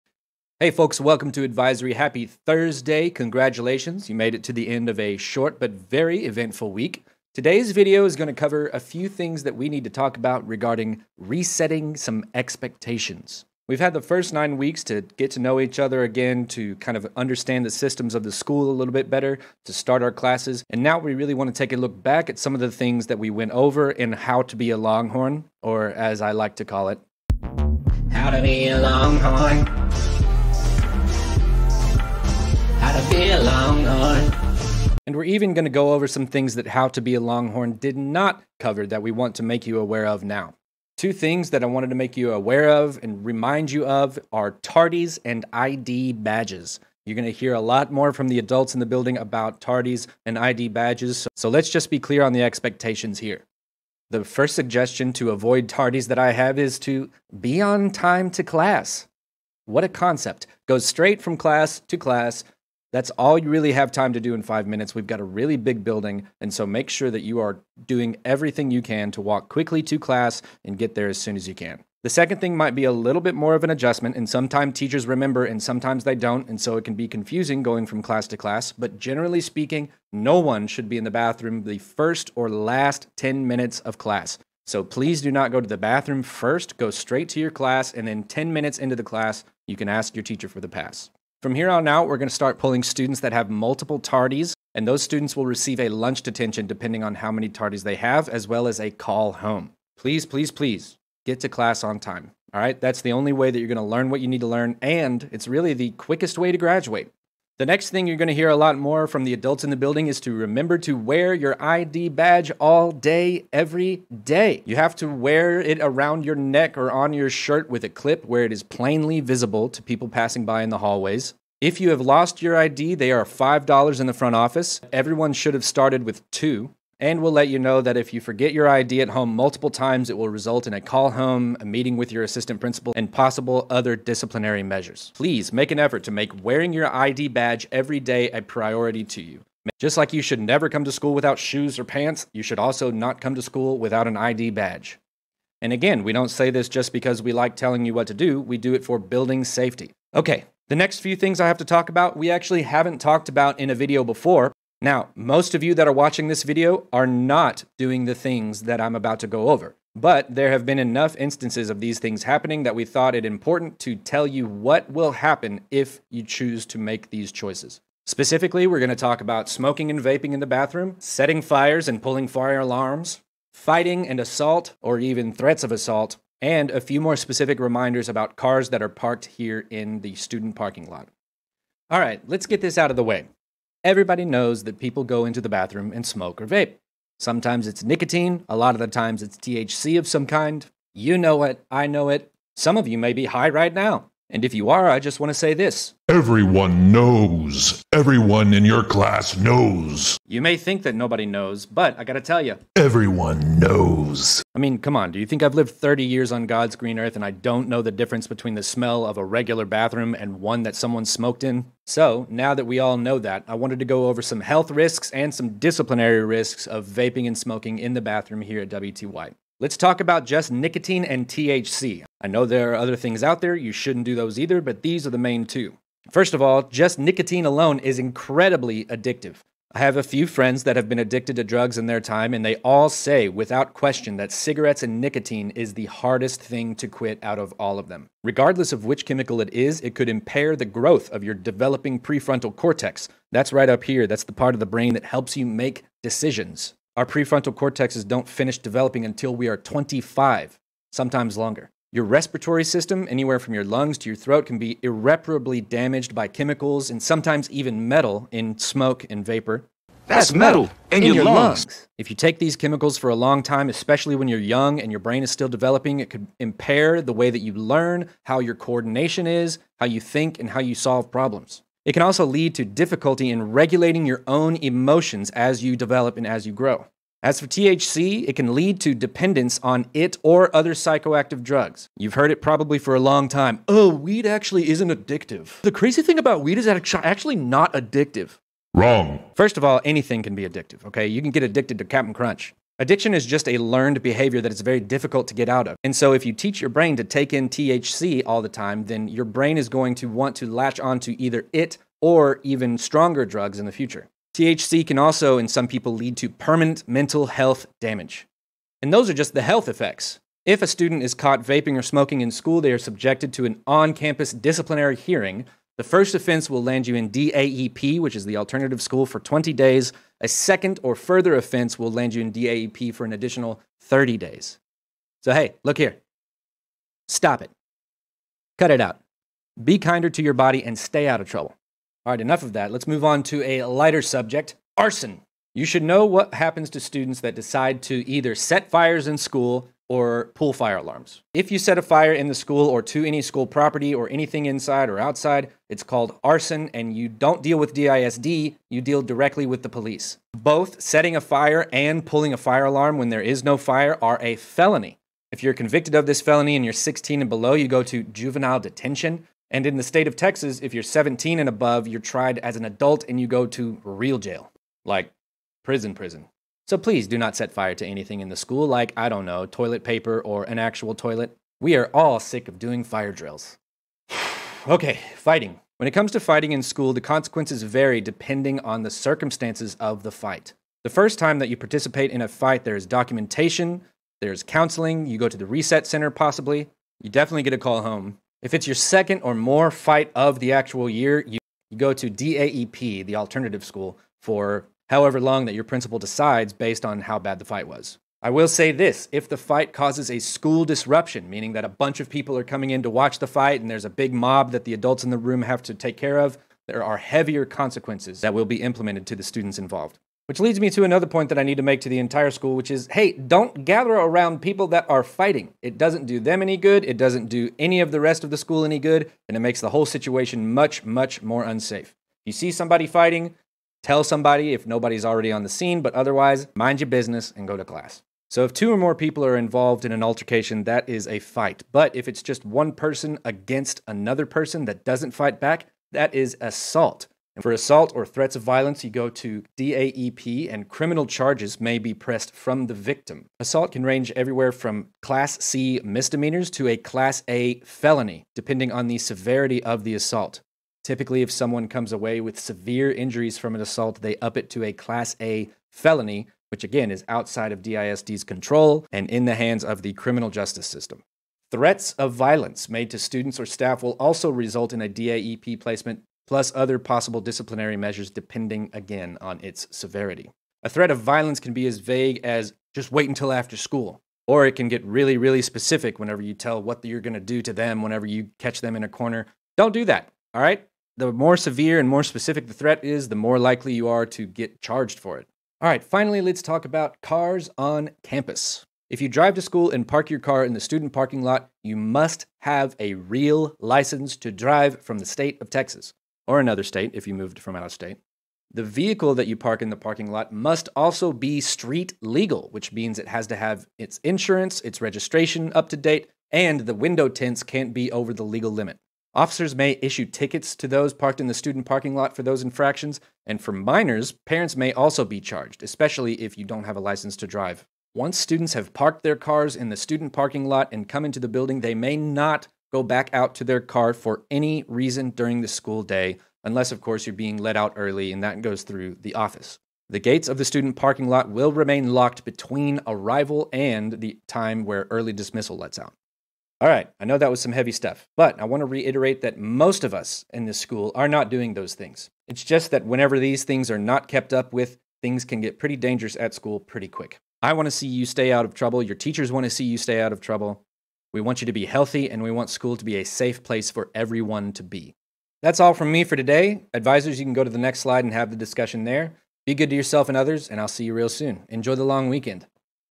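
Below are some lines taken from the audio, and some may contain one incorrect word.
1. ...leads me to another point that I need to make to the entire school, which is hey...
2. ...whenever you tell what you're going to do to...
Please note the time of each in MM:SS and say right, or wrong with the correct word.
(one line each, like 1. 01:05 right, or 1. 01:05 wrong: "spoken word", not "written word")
1. 06:50 right
2. 07:55 right.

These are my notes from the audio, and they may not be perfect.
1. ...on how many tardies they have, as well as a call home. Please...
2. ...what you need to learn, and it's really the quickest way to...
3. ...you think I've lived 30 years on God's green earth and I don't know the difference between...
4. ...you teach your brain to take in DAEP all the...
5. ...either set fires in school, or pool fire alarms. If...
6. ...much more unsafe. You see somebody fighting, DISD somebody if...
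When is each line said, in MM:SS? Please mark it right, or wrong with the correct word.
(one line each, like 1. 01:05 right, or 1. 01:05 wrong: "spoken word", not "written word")
1. 01:37 right
2. 01:44 right
3. 03:25 right
4. 04:56 wrong: "THC", not "DAEP"
5. 05:38 right
6. 07:00 wrong: "Tell", not "DISD".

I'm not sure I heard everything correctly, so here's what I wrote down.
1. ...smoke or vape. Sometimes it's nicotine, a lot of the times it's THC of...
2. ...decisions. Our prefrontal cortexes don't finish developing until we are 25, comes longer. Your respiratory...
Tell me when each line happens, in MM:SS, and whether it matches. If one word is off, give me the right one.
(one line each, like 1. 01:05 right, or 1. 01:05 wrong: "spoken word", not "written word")
1. 03:06 right
2. 04:06 wrong: "sometimes", not "comes".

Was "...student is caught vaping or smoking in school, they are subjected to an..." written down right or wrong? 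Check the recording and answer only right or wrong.
right.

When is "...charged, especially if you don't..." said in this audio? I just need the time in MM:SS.
08:35.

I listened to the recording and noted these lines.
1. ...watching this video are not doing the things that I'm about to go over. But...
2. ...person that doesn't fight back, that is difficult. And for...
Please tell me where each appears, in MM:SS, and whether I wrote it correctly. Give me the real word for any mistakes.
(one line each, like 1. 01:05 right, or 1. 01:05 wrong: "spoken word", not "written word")
1. 02:35 right
2. 07:14 wrong: "assault", not "difficult".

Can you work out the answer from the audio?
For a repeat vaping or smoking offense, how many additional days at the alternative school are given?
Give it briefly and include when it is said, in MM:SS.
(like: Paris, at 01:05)
30 days, at 05:23.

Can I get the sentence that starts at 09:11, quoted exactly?
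We want you to be healthy, and we want school to be a safe place for everyone to be.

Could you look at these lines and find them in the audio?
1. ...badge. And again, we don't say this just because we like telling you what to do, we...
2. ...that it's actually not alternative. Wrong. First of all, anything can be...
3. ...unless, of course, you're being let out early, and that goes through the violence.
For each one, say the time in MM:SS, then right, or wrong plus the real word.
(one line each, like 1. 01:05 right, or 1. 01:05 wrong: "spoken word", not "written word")
1. 02:24 right
2. 04:46 wrong: "addictive", not "alternative"
3. 08:46 wrong: "office", not "violence".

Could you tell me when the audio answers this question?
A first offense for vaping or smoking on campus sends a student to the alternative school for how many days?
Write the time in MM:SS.
05:19.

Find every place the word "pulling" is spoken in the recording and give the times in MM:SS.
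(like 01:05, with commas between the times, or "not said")
01:32, 02:52, 05:52.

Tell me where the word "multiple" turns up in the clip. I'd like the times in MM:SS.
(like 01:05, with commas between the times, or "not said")
01:33, 02:09.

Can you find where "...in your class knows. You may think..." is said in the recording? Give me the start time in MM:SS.
03:18.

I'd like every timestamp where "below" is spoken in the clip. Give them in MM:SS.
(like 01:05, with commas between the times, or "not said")
05:57.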